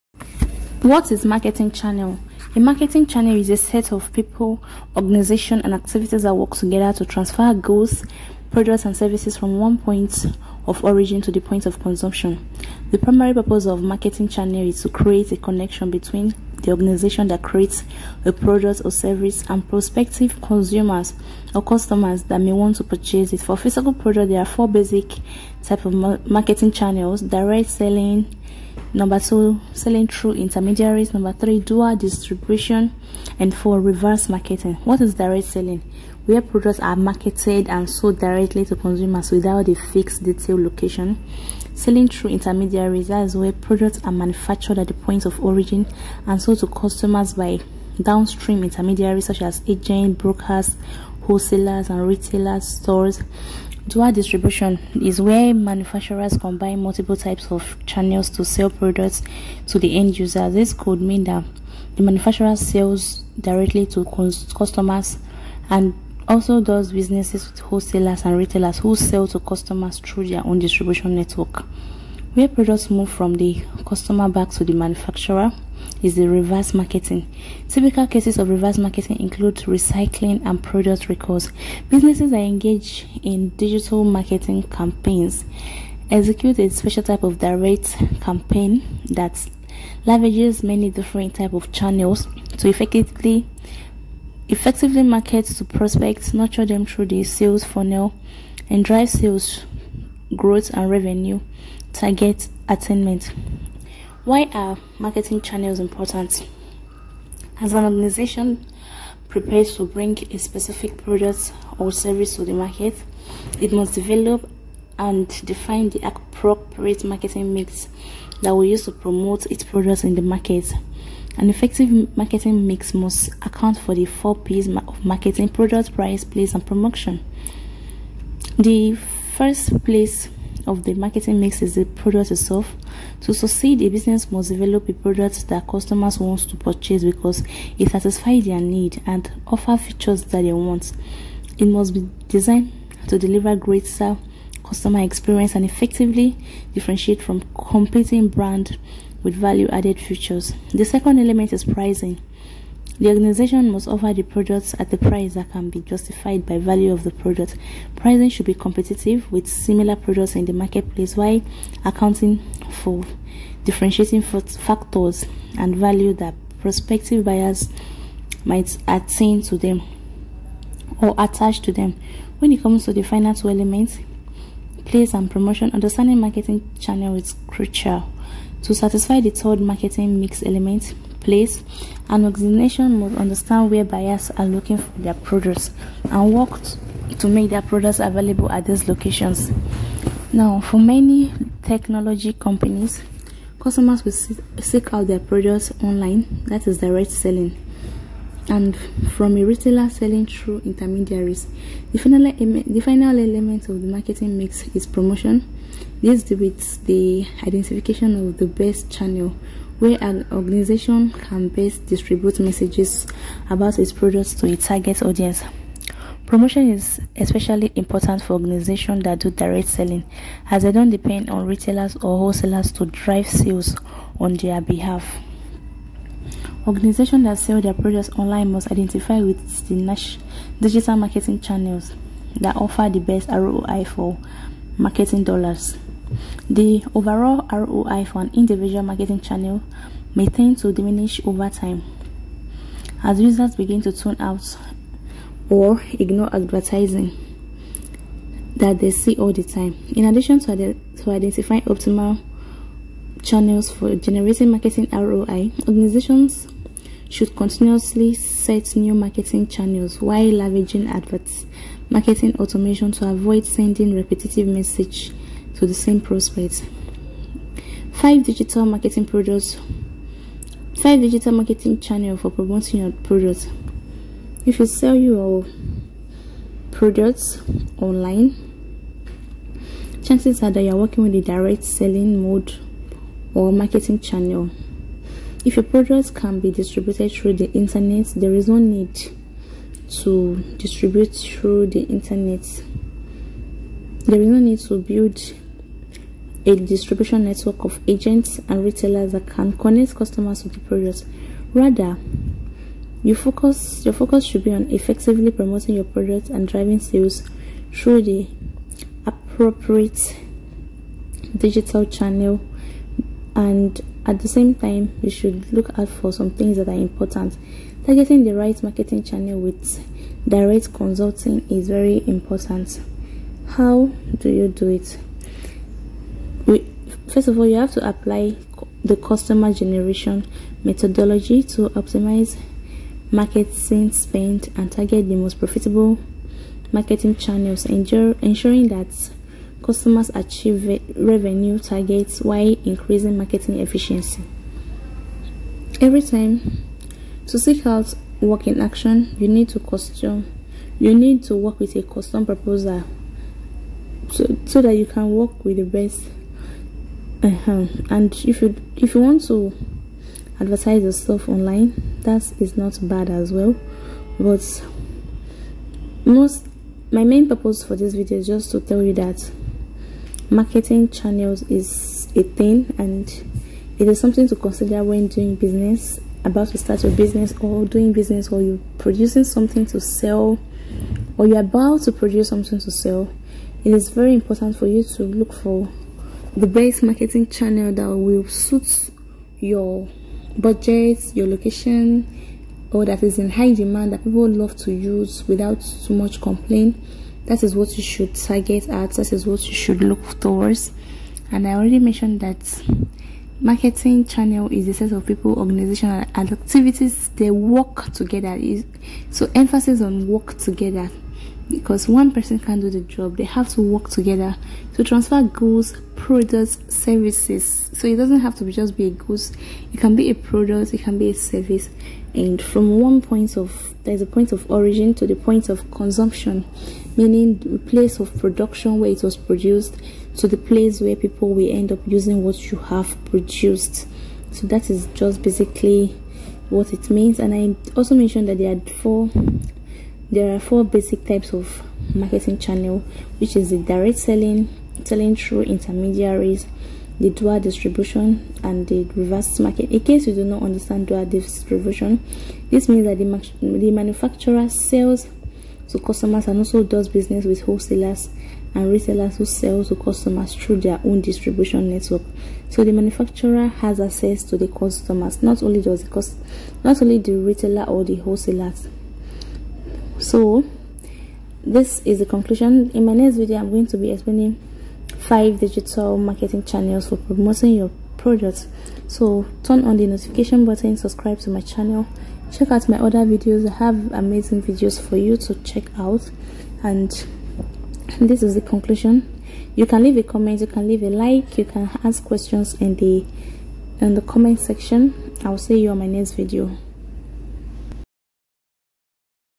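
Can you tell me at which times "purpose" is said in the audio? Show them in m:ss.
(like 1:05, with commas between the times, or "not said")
0:13, 6:07.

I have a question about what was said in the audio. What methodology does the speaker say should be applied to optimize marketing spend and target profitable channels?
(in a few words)
Customer generation methodology.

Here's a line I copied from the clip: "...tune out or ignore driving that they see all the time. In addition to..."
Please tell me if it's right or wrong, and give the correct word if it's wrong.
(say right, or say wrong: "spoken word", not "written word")
wrong: "advertising", not "driving".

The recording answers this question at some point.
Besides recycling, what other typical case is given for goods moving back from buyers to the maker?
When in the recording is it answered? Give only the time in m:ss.
1:20.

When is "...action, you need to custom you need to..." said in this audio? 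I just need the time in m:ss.
5:48.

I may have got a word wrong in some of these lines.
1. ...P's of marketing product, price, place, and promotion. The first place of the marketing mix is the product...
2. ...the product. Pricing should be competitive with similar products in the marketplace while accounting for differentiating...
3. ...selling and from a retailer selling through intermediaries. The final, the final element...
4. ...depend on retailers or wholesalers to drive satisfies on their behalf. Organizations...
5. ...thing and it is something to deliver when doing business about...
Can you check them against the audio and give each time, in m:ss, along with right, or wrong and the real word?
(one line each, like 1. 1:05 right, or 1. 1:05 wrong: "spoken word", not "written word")
1. 2:04 right
2. 2:37 right
3. 3:17 right
4. 3:40 wrong: "sales", not "satisfies"
5. 6:12 wrong: "consider", not "deliver".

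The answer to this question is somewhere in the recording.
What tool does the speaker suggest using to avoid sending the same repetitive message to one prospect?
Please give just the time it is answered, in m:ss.
4:21.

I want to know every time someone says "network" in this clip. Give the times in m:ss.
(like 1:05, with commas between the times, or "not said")
1:11, 4:57, 7:41.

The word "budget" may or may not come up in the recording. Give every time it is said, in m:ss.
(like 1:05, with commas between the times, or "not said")
6:30.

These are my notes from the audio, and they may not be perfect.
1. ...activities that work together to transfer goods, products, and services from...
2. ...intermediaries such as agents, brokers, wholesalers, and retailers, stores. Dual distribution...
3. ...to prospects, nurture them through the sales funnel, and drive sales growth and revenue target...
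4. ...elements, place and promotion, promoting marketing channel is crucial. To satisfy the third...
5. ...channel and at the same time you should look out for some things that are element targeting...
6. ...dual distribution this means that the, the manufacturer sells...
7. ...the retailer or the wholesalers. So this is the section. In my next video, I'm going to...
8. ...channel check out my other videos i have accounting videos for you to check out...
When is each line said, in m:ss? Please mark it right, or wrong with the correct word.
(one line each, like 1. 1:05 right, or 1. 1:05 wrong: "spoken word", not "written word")
1. 0:05 right
2. 0:48 right
3. 1:35 right
4. 2:53 wrong: "understanding", not "promoting"
5. 5:11 wrong: "important", not "element"
6. 7:30 right
7. 7:46 wrong: "conclusion", not "section"
8. 8:01 wrong: "amazing", not "accounting".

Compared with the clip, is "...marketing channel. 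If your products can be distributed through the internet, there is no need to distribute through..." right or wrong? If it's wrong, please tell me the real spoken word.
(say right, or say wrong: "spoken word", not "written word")
right.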